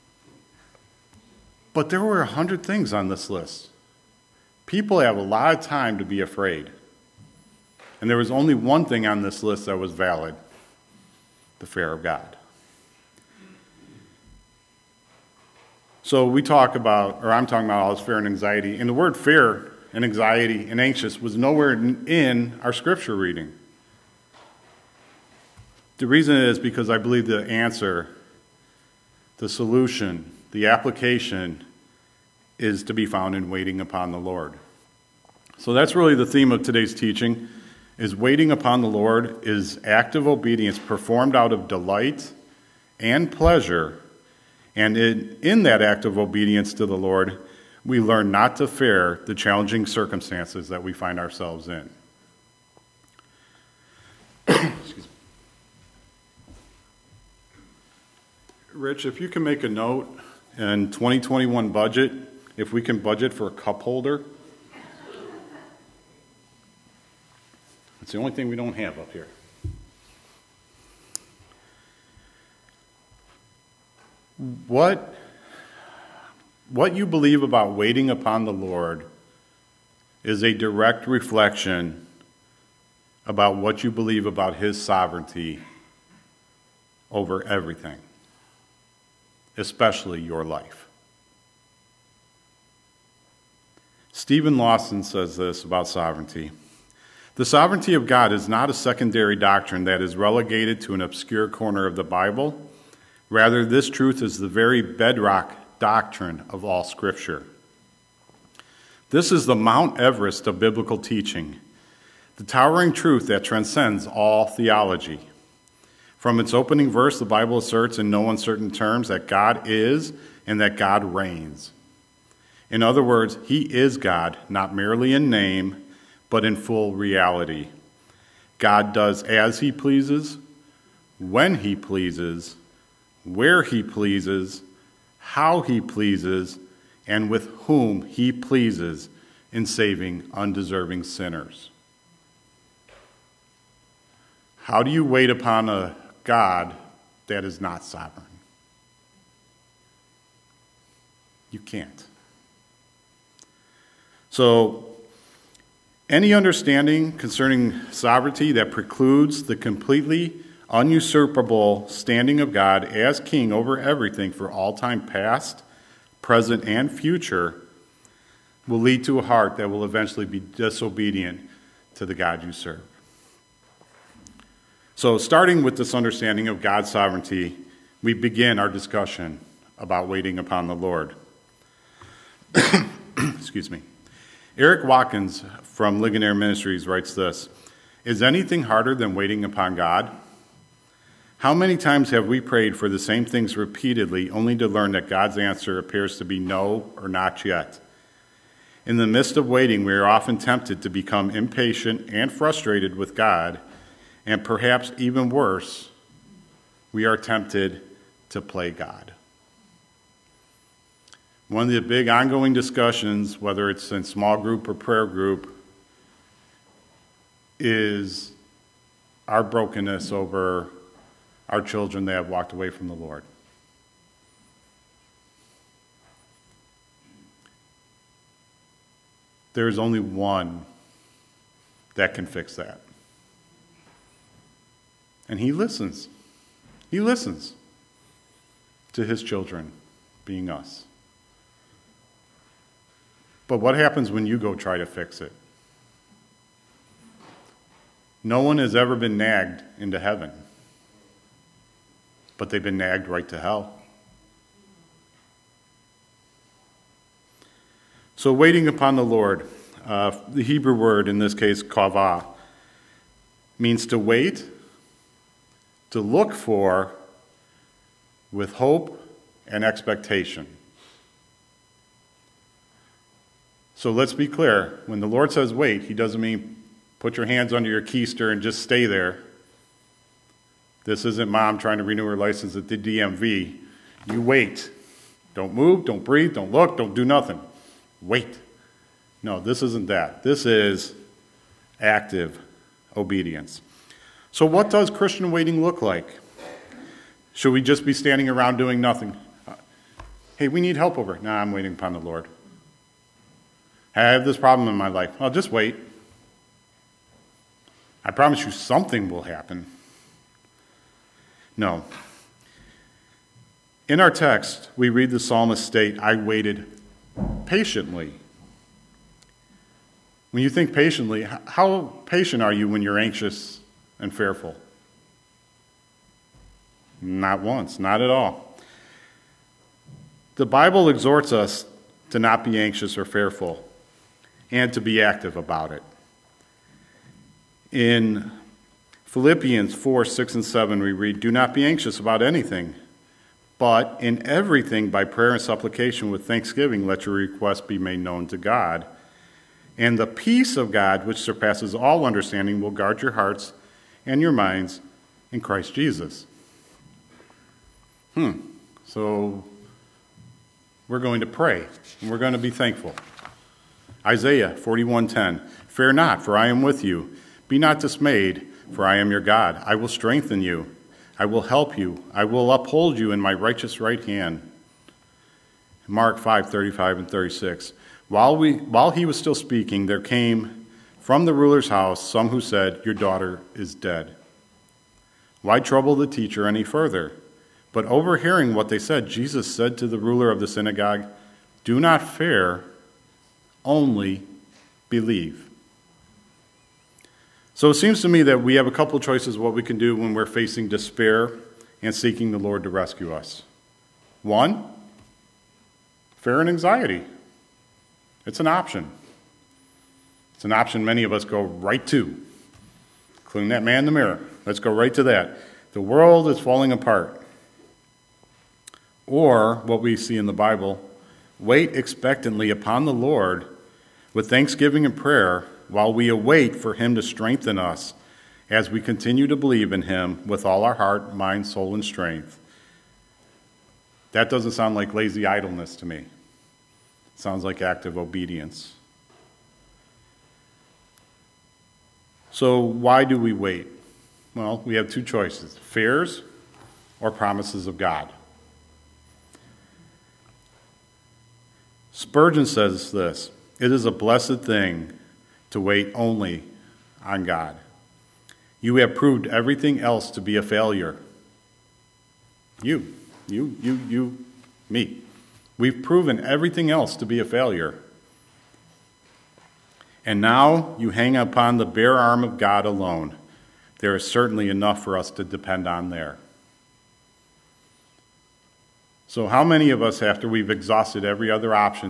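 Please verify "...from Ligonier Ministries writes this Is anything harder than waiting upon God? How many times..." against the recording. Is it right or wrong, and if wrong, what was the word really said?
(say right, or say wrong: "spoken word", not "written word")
right.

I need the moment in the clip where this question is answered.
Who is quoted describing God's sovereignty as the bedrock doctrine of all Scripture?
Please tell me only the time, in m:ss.
1:34.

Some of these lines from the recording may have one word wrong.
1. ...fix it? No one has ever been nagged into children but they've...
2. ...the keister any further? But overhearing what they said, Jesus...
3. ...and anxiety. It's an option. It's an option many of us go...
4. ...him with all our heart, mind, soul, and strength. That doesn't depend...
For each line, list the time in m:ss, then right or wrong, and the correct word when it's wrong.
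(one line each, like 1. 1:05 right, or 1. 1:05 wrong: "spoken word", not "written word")
1. 4:04 wrong: "heaven", not "children"
2. 6:25 wrong: "teacher", not "keister"
3. 6:46 right
4. 7:09 wrong: "sound", not "depend".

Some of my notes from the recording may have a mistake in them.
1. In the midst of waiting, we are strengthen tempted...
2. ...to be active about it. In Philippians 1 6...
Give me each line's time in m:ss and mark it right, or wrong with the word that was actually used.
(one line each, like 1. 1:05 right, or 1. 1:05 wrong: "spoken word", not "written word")
1. 3:18 wrong: "often", not "strengthen"
2. 5:34 wrong: "4", not "1".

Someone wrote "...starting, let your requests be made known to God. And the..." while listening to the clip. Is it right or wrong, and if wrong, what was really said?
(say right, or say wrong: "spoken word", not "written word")
wrong: "thanksgiving", not "starting".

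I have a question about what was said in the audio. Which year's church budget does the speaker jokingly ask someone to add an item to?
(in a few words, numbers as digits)
2021.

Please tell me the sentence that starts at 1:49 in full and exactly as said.
This is the Mount Everest of biblical teaching, the towering truth that transcends all theology.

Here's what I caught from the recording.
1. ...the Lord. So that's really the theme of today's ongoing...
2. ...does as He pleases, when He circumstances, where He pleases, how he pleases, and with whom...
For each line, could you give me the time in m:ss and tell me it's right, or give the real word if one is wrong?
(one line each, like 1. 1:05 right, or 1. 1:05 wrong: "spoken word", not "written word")
1. 0:34 wrong: "teaching", not "ongoing"
2. 2:08 wrong: "pleases", not "circumstances".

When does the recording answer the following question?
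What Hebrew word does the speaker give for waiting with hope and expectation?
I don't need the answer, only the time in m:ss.
4:21.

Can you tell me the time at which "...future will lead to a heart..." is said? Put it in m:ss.
2:46.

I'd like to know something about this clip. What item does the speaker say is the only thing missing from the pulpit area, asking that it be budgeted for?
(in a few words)
Cup holder.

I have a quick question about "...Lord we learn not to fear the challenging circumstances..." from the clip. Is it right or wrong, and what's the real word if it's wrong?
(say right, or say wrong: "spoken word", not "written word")
right.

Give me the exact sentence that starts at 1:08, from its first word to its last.
It's the only thing we don't have up here.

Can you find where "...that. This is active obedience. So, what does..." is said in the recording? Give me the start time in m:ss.
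4:49.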